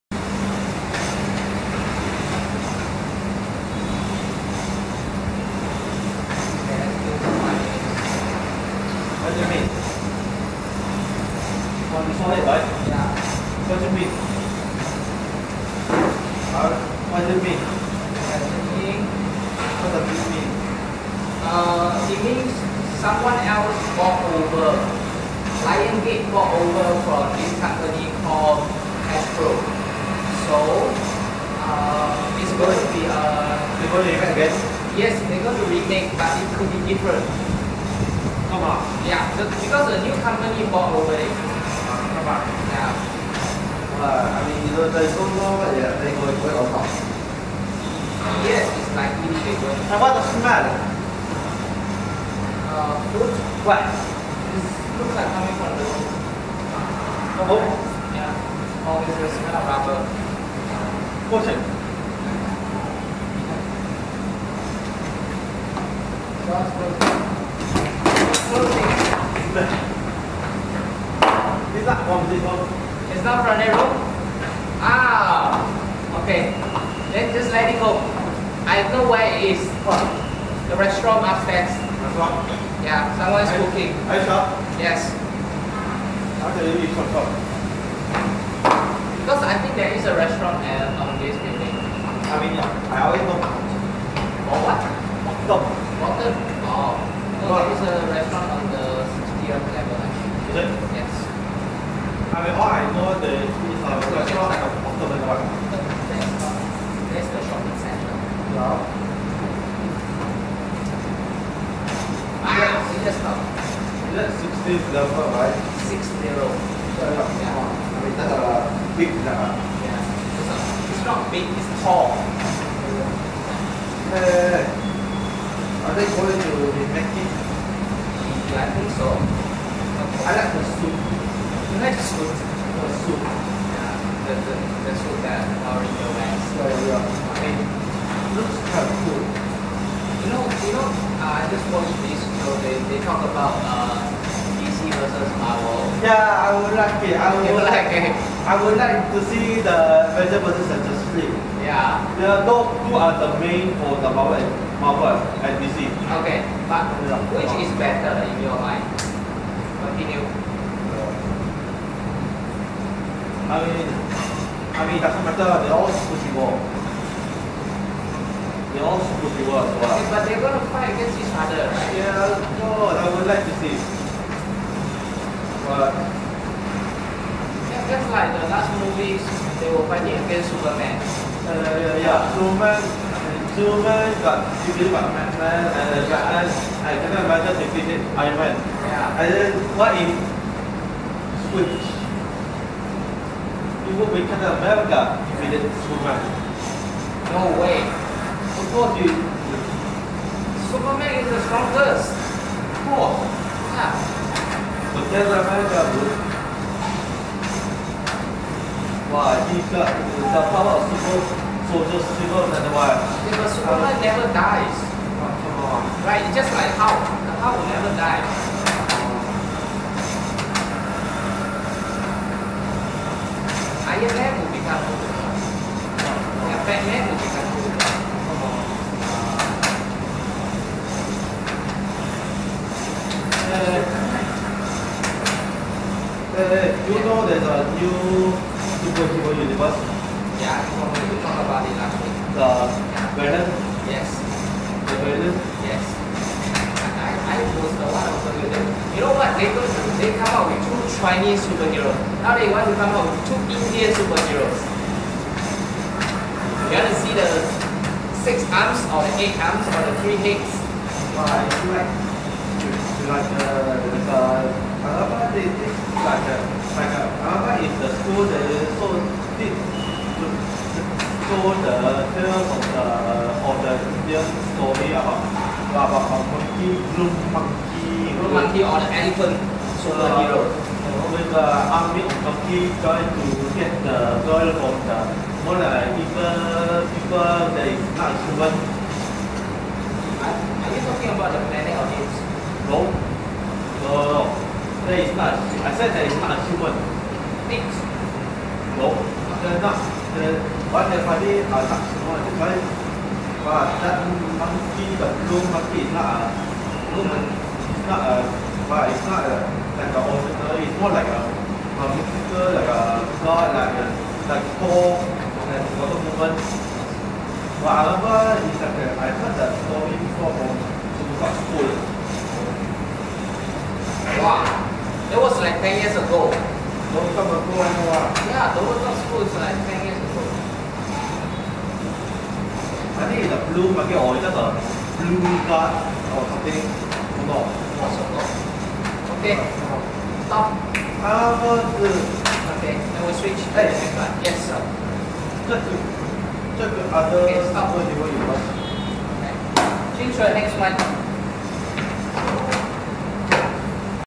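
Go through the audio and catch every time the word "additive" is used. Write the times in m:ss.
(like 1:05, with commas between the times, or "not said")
not said.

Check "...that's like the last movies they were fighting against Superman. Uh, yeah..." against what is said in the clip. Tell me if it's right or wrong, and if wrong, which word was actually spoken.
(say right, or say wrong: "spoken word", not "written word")
right.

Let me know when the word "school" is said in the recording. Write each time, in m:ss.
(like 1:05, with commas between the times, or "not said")
4:27, 5:29.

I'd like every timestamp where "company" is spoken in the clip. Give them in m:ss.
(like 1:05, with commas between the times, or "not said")
0:27, 0:40.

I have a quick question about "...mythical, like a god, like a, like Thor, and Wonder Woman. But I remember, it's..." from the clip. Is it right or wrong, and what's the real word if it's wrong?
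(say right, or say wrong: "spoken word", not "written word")
right.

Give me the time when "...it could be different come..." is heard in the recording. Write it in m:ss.
0:36.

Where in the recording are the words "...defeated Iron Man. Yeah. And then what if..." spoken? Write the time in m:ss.
3:07.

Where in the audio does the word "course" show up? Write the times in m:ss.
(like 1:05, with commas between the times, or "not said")
3:18, 3:22.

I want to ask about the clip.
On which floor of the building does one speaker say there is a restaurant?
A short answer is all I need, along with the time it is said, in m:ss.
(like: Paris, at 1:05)
60th, at 1:39.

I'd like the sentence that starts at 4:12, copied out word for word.
Now they want to come out with two Indian superheroes.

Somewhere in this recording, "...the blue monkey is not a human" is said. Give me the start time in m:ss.
5:04.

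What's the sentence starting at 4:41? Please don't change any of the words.
the army monkey trying to get the the more like people people Are, are you talking about the planet of this?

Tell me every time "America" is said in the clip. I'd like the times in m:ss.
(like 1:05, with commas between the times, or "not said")
3:07, 3:14, 3:25.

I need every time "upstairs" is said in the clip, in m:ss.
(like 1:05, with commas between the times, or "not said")
1:21.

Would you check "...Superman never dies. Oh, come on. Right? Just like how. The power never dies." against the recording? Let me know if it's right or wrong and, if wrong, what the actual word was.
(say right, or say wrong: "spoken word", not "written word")
right.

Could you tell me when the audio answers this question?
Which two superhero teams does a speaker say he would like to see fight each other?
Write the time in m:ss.
2:30.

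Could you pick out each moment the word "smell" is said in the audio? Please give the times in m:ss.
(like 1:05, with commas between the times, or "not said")
0:50, 0:59.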